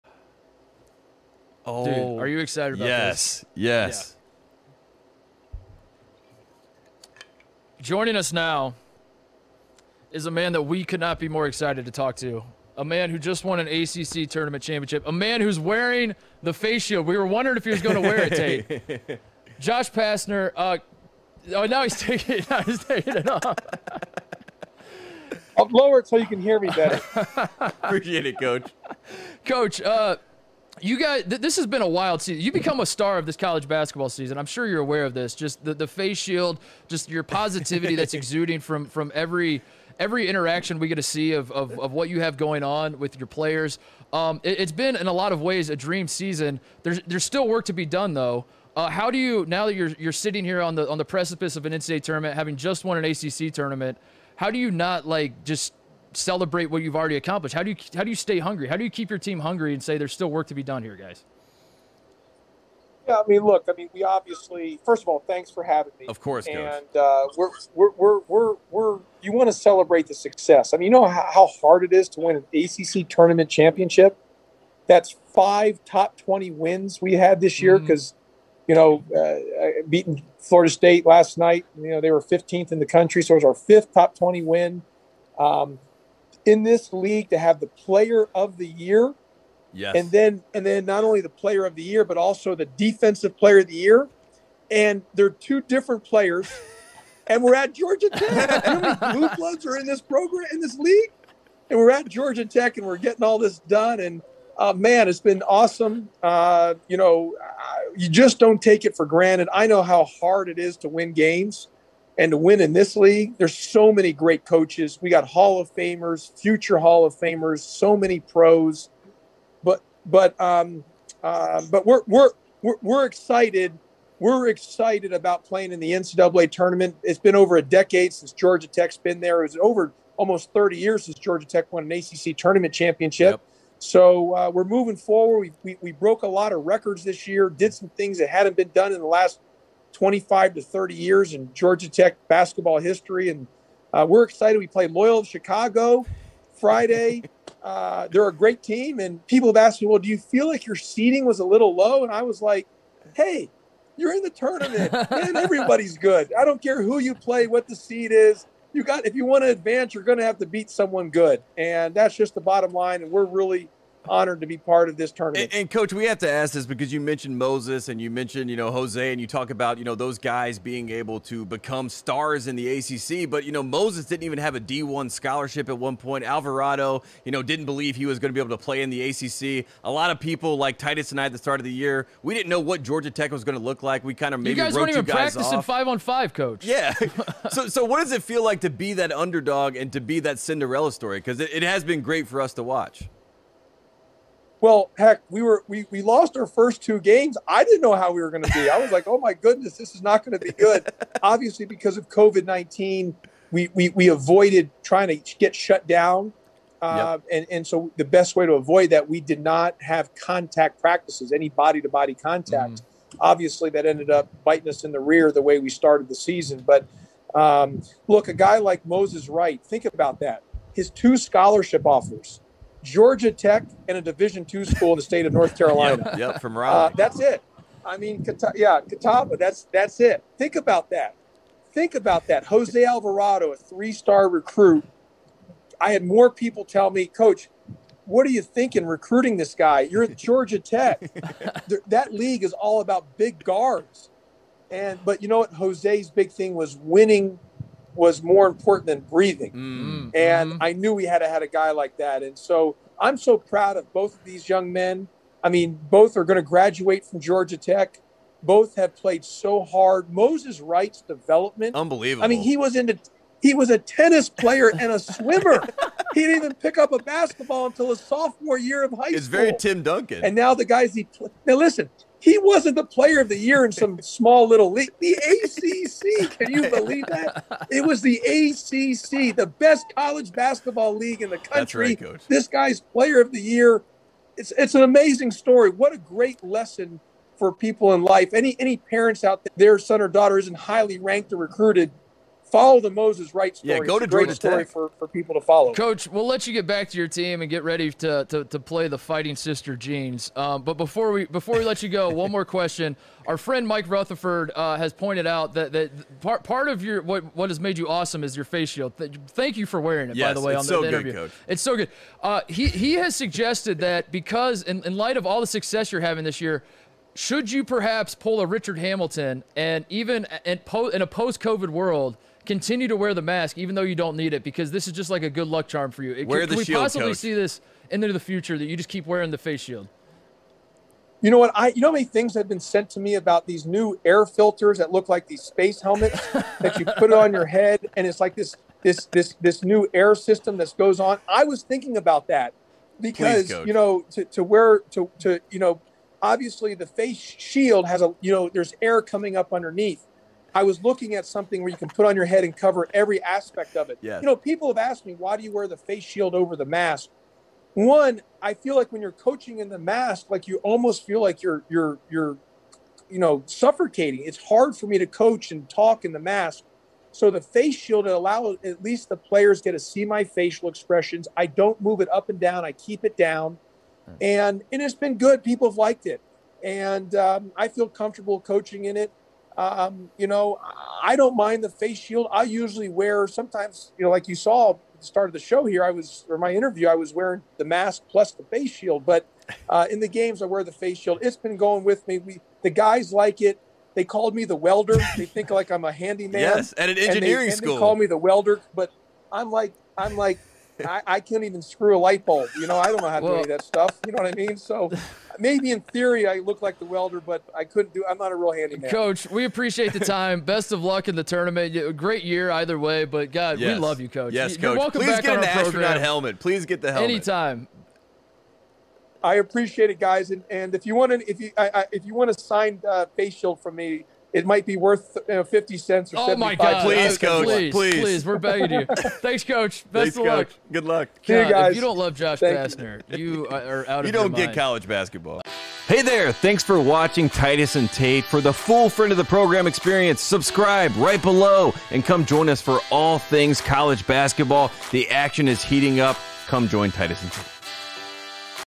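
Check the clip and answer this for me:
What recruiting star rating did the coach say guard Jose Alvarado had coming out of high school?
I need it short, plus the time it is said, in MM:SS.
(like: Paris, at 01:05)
three-star, at 03:53.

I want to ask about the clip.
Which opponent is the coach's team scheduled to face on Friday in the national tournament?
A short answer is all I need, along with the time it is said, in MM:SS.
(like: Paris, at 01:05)
Loyola of Chicago, at 02:24.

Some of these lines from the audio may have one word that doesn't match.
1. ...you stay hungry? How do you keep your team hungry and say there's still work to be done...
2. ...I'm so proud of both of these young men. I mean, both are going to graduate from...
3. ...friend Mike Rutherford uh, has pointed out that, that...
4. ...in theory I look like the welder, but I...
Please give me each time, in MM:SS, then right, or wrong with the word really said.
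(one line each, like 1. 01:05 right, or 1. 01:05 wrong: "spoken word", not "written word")
1. 00:58 right
2. 04:12 right
3. 05:03 right
4. 06:45 right.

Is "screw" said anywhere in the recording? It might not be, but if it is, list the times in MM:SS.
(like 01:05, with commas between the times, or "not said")
06:41.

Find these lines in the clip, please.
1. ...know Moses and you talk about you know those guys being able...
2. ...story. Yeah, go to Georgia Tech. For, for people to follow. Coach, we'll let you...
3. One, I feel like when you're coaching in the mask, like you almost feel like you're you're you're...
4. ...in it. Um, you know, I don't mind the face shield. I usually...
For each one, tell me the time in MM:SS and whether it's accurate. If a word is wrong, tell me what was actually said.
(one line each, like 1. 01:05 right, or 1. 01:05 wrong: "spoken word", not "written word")
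1. 02:48 wrong: "Jose", not "Moses"
2. 04:53 right
3. 05:57 right
4. 06:18 right.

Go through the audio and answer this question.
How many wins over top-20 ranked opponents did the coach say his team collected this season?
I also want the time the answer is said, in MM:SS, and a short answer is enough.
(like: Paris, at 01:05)
5, at 01:15.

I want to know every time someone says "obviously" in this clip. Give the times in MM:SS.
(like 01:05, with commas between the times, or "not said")
01:04, 03:21, 03:33, 05:46.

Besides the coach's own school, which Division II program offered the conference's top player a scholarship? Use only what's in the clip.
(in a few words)
Catawba.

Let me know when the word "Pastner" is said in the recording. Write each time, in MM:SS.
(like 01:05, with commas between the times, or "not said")
00:19, 07:12.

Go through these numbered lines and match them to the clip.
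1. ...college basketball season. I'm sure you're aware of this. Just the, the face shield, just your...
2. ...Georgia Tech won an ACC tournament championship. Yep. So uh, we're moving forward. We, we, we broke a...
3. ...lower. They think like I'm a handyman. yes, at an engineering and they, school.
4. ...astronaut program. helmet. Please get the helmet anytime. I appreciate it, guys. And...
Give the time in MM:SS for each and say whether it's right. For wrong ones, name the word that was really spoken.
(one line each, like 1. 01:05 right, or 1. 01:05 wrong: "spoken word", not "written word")
1. 00:33 right
2. 02:11 right
3. 06:34 wrong: "welder", not "lower"
4. 06:55 right.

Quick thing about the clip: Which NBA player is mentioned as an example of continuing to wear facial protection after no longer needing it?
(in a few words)
Richard Hamilton.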